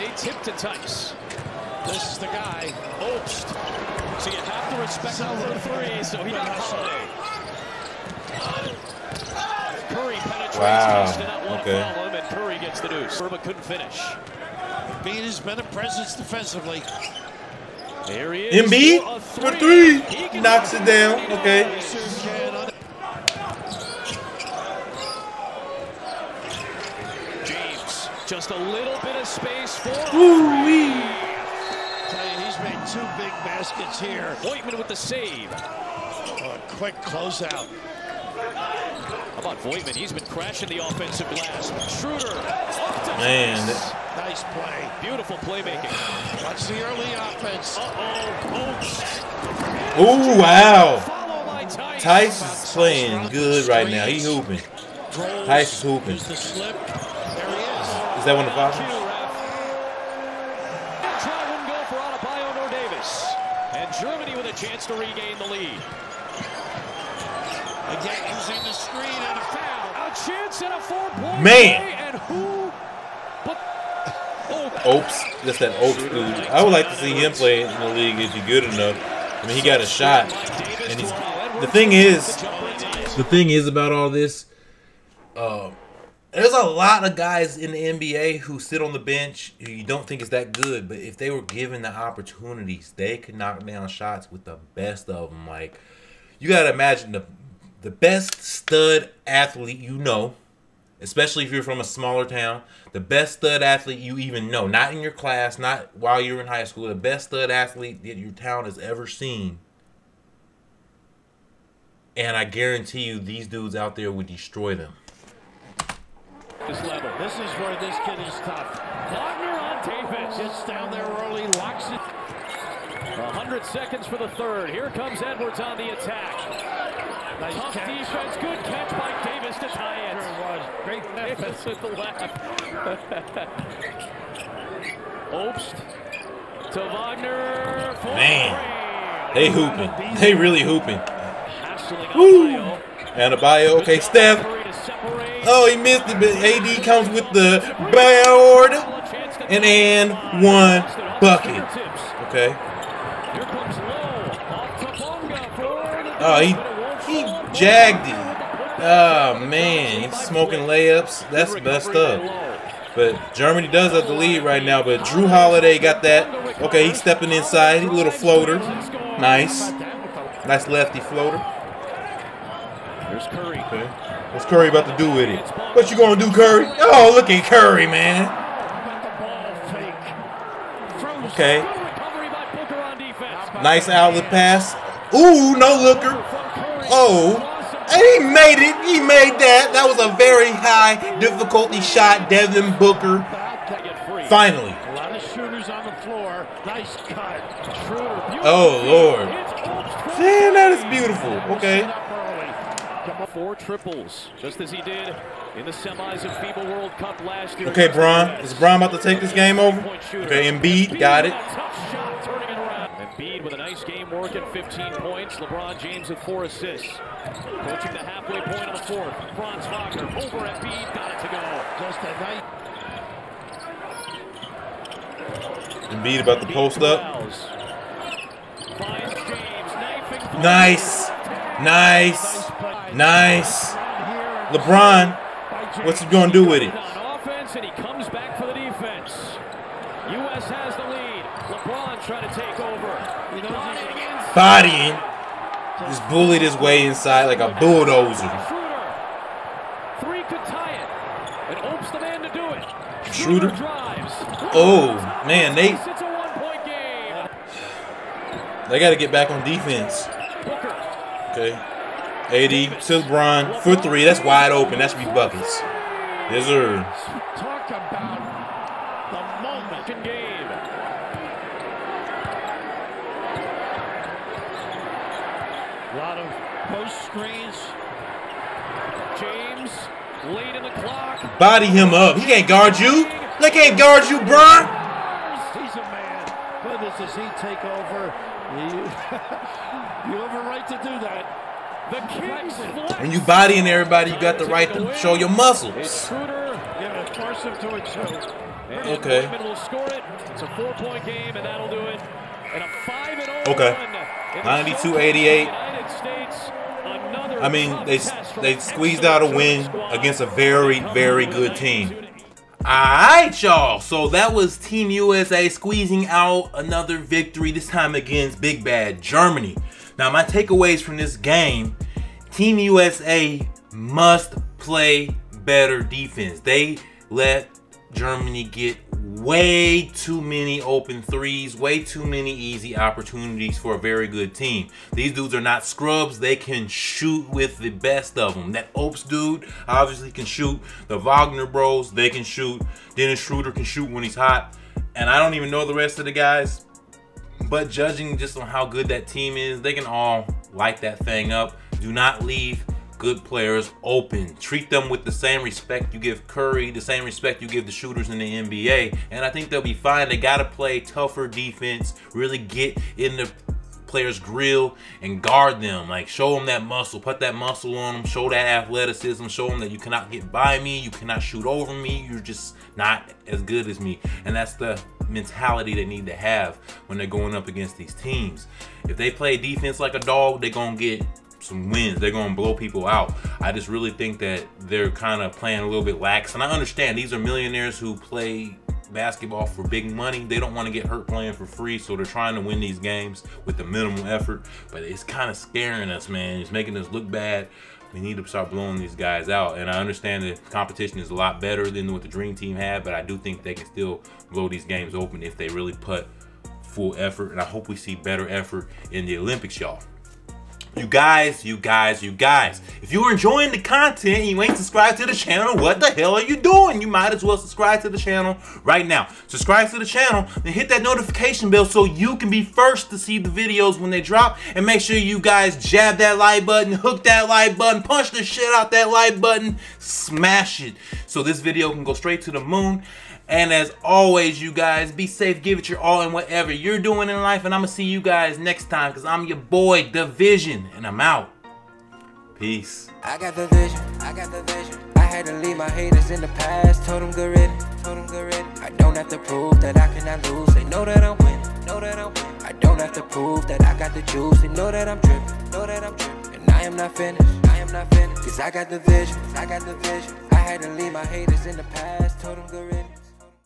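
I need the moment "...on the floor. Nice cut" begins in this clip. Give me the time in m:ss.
3:15.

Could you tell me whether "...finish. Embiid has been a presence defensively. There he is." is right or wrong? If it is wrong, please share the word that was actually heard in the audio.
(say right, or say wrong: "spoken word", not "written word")
right.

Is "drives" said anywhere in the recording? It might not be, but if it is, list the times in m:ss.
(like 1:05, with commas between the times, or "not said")
4:13.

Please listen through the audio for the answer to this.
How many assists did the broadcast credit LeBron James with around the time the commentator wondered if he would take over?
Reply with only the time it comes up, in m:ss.
3:36.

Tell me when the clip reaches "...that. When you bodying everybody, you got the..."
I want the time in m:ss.
4:51.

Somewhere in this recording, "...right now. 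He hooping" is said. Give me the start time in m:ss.
0:53.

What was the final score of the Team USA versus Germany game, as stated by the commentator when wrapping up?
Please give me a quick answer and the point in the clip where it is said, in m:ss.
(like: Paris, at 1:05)
92-88, at 5:04.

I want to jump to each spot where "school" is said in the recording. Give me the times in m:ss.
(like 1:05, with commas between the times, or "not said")
1:46.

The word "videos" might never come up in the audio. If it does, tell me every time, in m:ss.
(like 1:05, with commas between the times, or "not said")
7:03, 7:11.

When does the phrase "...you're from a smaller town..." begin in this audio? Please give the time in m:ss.
1:41.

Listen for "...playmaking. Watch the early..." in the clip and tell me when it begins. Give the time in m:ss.
0:45.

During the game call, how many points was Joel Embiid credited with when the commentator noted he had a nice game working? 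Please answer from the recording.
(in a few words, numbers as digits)
15.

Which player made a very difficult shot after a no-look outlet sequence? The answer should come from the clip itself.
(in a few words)
Devin Booker.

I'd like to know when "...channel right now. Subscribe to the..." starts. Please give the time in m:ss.
6:57.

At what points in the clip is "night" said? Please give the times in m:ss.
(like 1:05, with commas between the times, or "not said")
3:42.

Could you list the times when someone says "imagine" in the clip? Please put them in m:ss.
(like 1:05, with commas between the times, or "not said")
1:36.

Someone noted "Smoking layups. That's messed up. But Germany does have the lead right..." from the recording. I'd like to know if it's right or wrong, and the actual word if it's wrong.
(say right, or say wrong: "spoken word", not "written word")
right.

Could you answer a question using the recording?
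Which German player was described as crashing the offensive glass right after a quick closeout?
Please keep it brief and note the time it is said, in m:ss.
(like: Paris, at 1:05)
Voigtmann, at 0:39.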